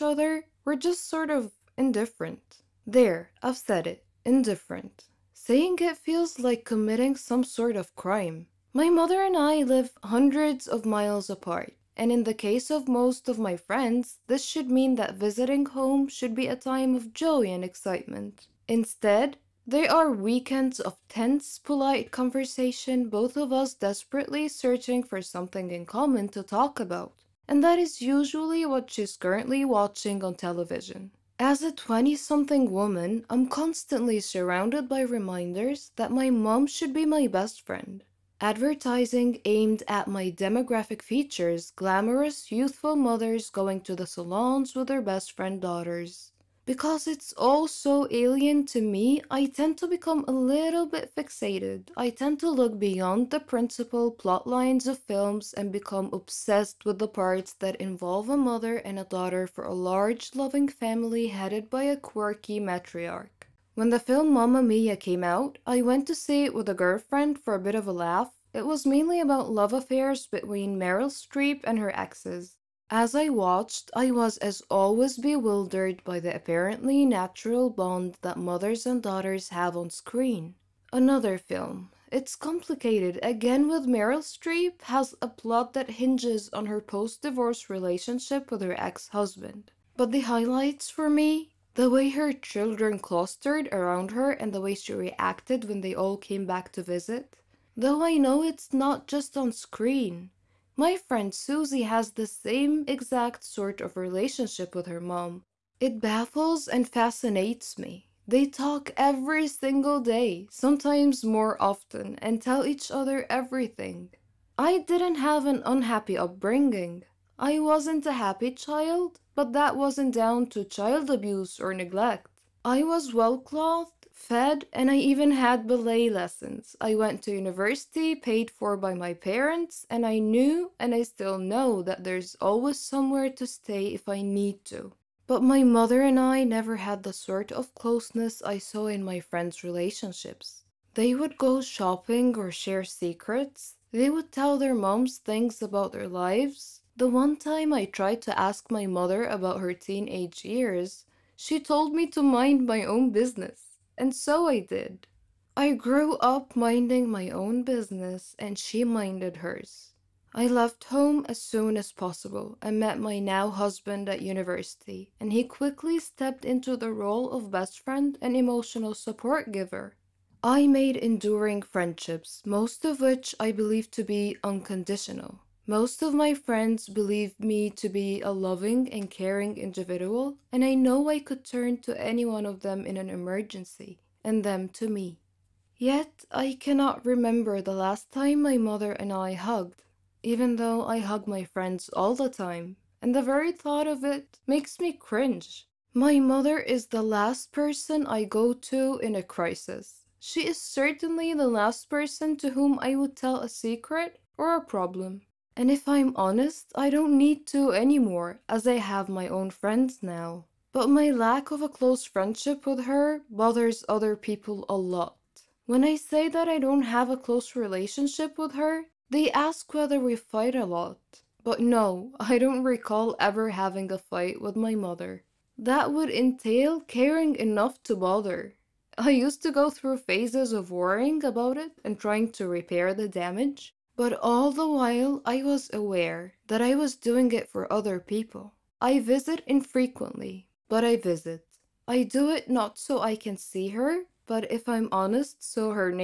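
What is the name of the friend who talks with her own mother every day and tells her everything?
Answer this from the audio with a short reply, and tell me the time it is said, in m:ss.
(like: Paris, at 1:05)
Susie, at 1:41.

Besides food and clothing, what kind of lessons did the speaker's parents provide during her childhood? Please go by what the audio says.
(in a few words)
Ballet.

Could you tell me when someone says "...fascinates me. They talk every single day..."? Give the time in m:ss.
1:46.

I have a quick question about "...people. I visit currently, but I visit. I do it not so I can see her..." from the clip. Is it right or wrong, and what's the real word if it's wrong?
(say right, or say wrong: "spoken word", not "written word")
wrong: "infrequently", not "currently".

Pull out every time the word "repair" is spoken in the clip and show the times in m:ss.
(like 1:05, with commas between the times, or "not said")
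3:52.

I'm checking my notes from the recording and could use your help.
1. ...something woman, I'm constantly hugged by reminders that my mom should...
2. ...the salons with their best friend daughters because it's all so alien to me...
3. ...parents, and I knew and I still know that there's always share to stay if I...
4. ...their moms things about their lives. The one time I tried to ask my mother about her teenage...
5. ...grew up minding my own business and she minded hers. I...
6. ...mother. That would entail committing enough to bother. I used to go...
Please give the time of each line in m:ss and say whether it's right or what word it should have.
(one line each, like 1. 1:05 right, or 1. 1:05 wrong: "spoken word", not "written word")
1. 0:32 wrong: "surrounded", not "hugged"
2. 0:43 right
3. 2:09 wrong: "somewhere", not "share"
4. 2:24 right
5. 2:35 right
6. 3:44 wrong: "caring", not "committing".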